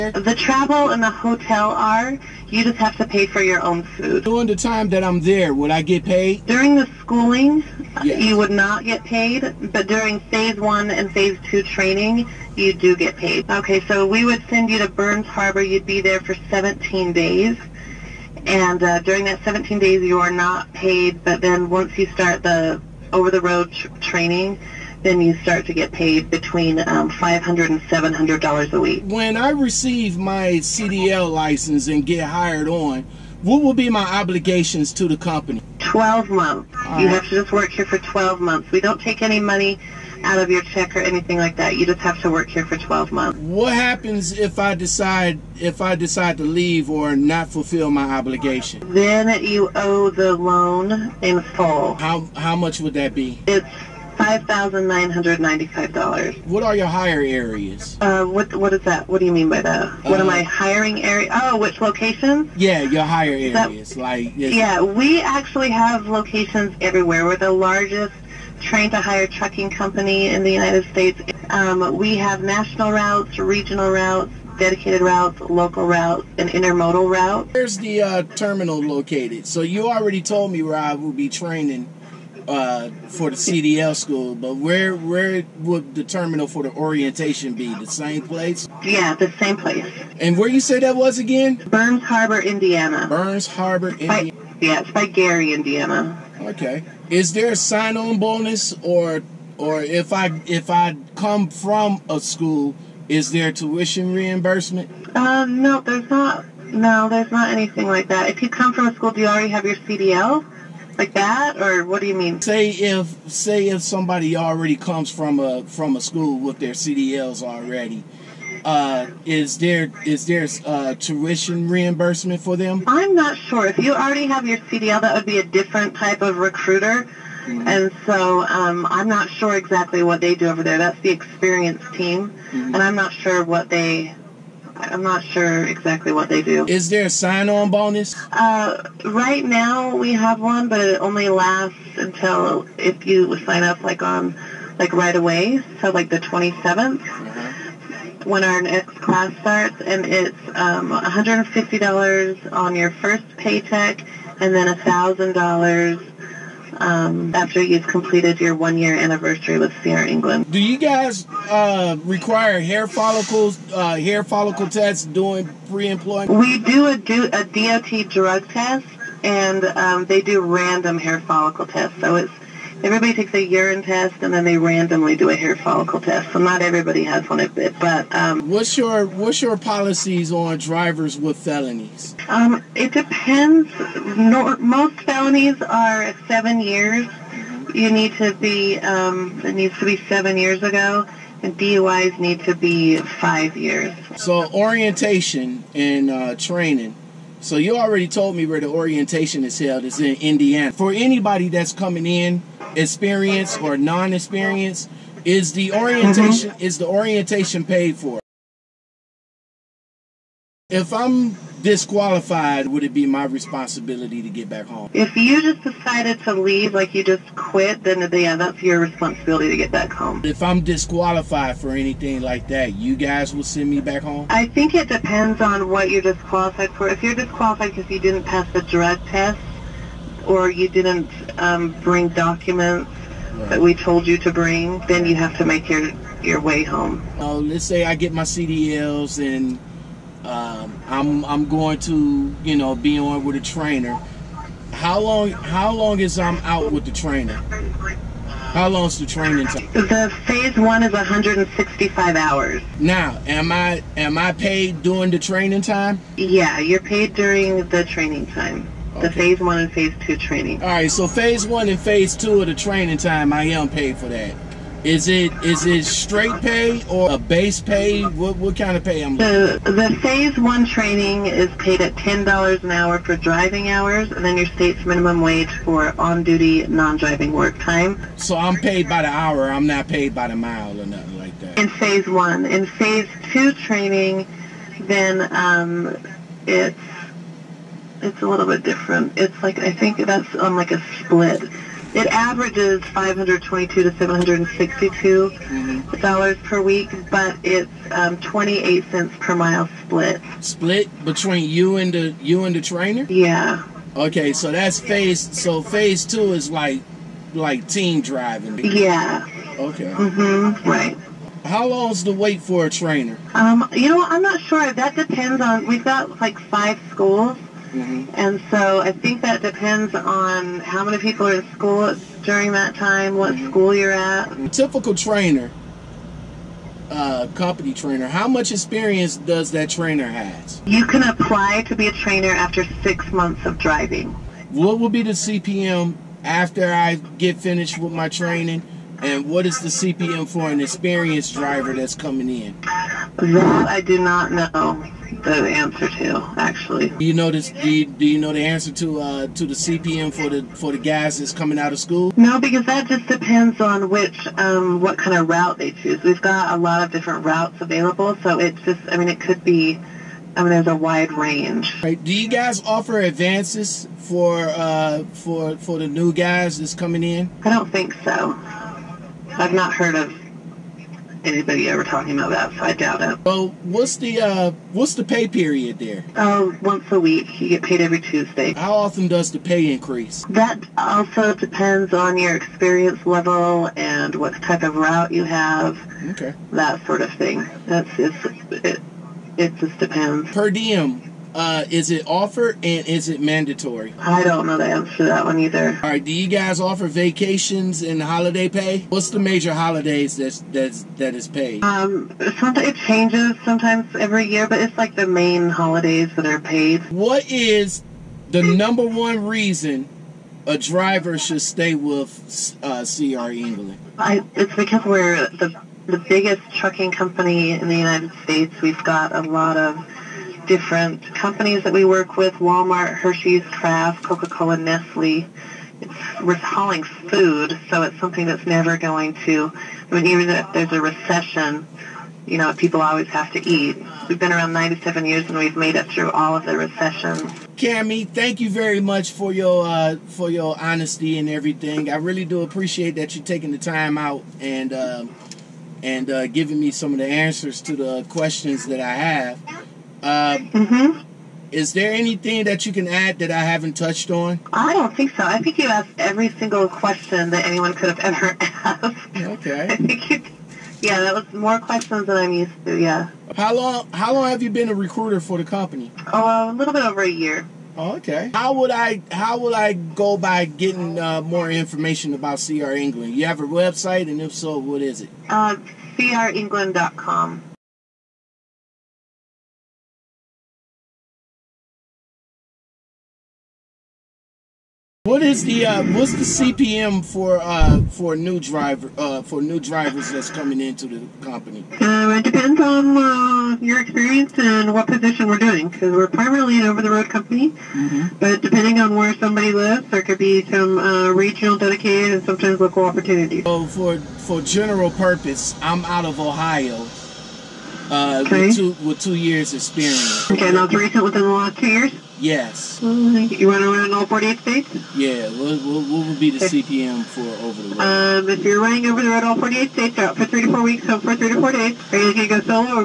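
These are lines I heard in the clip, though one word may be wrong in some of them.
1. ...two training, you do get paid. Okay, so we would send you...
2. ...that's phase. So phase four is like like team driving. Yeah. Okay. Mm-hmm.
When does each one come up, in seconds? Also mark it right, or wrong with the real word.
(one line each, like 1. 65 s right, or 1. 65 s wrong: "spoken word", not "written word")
1. 11 s right
2. 304 s wrong: "two", not "four".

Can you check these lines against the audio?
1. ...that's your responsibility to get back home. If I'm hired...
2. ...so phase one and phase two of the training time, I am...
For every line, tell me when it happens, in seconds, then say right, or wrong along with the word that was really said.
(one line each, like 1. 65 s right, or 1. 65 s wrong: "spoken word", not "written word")
1. 218 s wrong: "disqualified", not "hired"
2. 260 s right.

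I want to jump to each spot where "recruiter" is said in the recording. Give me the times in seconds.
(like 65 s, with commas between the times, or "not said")
126 s, 464 s.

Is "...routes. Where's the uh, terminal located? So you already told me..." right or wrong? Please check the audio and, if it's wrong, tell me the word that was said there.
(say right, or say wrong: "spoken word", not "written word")
right.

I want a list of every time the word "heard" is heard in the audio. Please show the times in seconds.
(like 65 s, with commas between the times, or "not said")
369 s.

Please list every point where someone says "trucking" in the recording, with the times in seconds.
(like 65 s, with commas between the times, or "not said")
69 s, 416 s.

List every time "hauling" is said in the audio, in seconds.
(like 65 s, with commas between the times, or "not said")
426 s.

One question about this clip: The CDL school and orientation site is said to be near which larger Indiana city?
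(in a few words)
Gary, Indiana.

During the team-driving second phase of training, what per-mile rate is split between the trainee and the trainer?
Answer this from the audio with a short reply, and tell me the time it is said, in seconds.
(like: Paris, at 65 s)
28 cents per mile, at 298 s.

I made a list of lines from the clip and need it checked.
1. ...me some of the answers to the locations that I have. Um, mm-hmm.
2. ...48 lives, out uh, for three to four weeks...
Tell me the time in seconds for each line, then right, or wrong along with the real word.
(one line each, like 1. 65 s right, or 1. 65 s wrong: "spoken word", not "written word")
1. 446 s wrong: "questions", not "locations"
2. 519 s wrong: "states", not "lives".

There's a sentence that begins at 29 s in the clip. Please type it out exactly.
When I receive my CDL license and get hired on, what will be my obligations to the company?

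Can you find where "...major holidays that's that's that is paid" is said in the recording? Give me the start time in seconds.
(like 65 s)
399 s.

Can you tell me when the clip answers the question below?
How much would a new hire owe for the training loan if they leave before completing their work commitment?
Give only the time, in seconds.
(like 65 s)
54 s.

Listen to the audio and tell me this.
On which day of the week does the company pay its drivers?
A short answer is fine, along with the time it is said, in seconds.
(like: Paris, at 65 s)
Tuesday, at 377 s.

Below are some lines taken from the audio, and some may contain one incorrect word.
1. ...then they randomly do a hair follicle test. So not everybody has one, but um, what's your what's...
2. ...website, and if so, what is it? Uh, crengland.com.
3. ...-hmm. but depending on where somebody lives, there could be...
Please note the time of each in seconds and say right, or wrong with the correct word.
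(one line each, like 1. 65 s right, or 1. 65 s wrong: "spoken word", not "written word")
1. 174 s right
2. 473 s right
3. 497 s right.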